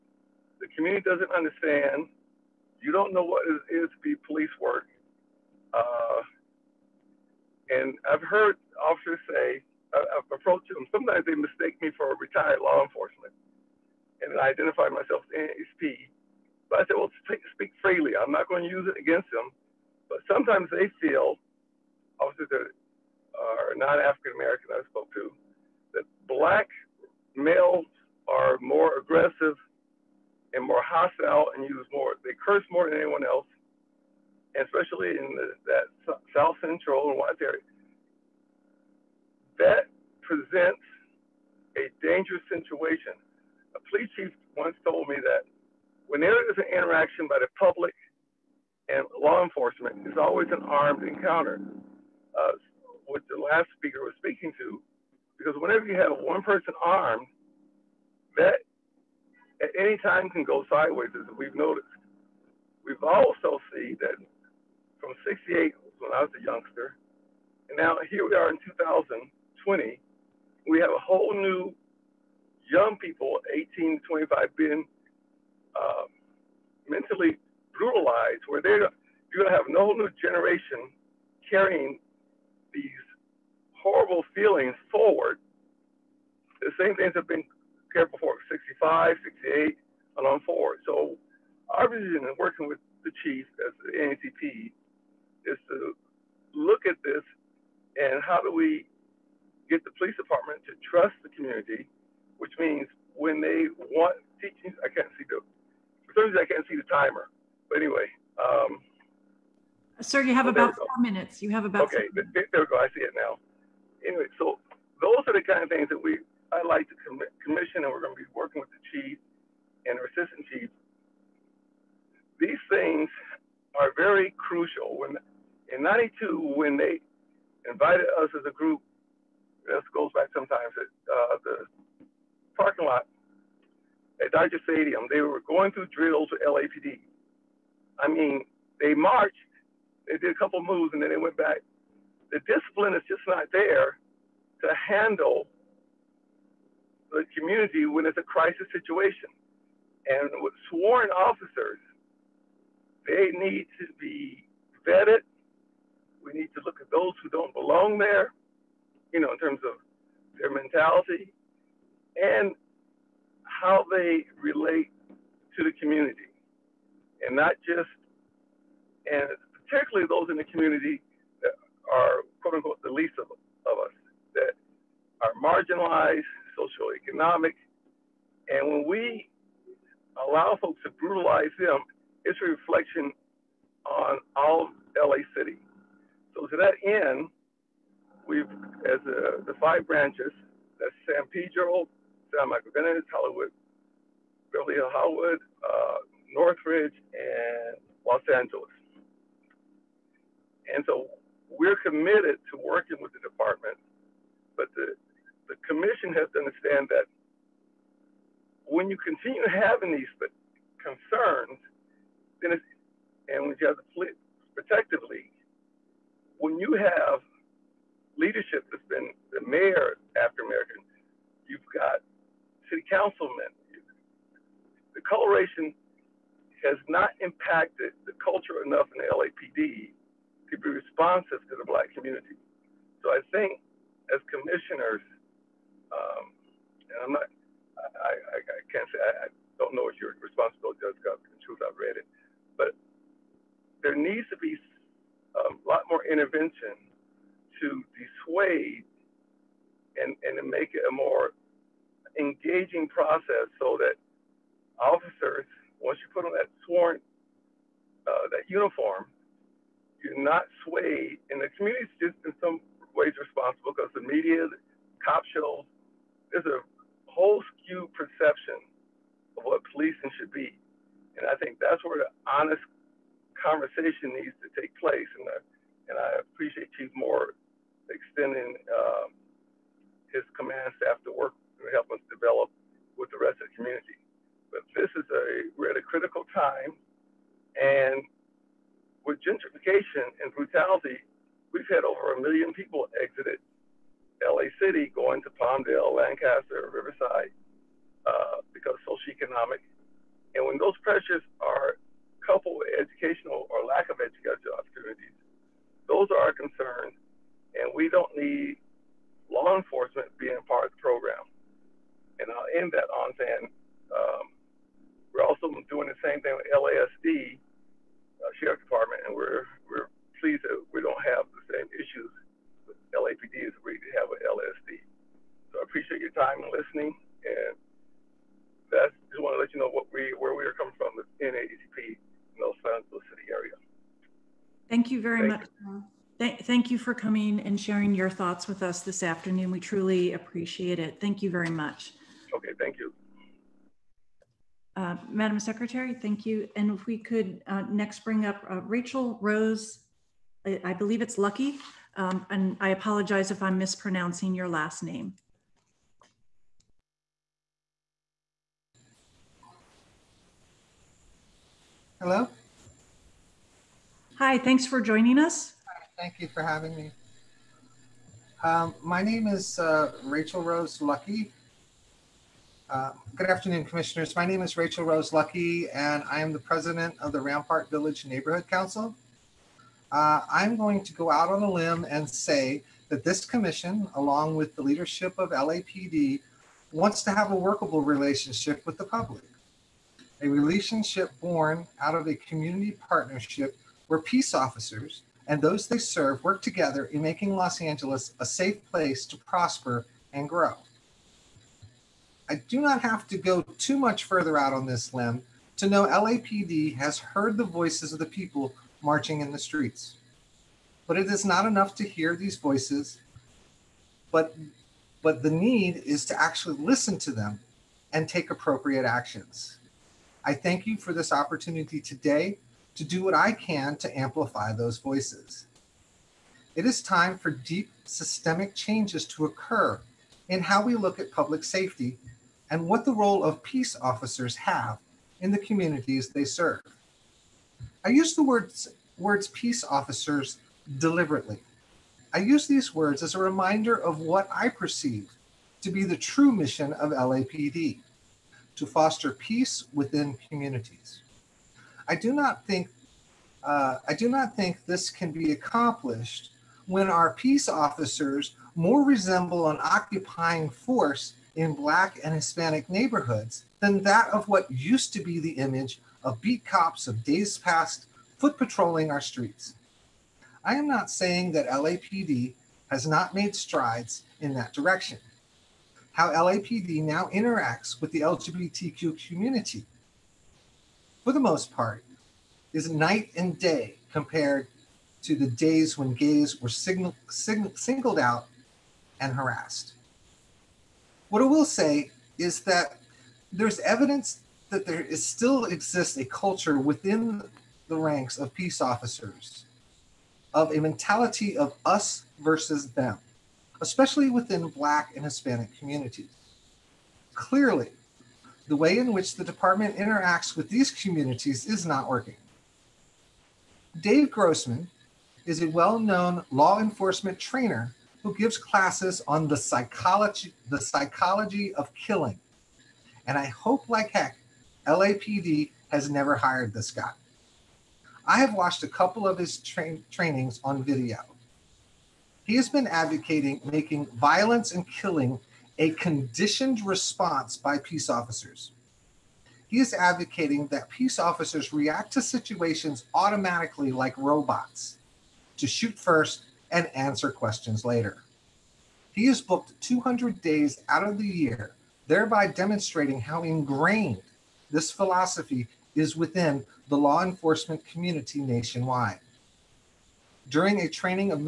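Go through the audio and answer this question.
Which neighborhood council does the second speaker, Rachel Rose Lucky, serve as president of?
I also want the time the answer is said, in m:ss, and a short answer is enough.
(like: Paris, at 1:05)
Rampart Village Neighborhood Council, at 6:17.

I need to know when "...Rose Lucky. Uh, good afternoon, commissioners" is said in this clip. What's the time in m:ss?
6:10.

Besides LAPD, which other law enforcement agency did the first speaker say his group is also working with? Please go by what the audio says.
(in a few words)
LASD.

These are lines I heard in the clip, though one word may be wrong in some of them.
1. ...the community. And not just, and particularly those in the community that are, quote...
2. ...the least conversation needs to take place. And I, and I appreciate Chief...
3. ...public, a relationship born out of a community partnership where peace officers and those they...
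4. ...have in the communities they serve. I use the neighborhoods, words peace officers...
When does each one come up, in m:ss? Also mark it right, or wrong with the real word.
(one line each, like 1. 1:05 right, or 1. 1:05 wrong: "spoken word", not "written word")
1. 2:45 right
2. 4:31 wrong: "honest", not "least"
3. 6:28 right
4. 7:14 wrong: "words", not "neighborhoods".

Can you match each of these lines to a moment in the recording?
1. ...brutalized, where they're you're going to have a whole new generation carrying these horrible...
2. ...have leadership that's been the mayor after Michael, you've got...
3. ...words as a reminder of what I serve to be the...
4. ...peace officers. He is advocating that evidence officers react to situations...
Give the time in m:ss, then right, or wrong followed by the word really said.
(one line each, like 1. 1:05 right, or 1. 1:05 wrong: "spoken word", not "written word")
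1. 1:17 right
2. 3:36 wrong: "American", not "Michael"
3. 7:22 wrong: "perceive", not "serve"
4. 8:57 wrong: "peace", not "evidence".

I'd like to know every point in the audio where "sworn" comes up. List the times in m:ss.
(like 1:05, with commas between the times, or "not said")
2:30, 4:16.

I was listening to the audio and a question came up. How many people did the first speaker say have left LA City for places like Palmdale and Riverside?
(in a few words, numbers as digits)
Over a million.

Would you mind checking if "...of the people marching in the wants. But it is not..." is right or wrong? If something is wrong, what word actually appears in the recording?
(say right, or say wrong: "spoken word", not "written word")
wrong: "streets", not "wants".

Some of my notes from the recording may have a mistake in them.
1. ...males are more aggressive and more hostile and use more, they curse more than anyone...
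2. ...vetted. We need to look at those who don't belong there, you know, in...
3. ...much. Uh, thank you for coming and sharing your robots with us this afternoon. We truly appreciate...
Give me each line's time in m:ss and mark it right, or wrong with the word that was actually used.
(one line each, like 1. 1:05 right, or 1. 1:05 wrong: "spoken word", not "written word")
1. 0:27 right
2. 2:34 right
3. 5:35 wrong: "thoughts", not "robots".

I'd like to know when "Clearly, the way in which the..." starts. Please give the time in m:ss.
8:27.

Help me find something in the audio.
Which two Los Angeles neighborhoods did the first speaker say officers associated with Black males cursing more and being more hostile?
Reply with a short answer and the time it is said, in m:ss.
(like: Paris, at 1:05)
South Central and Watts, at 0:36.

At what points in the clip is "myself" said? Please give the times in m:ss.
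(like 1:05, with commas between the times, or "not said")
0:14.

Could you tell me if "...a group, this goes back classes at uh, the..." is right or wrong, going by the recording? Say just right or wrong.
wrong.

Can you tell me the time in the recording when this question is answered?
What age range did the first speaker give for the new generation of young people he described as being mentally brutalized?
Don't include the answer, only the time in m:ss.
1:13.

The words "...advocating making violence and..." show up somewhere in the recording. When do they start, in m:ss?
8:52.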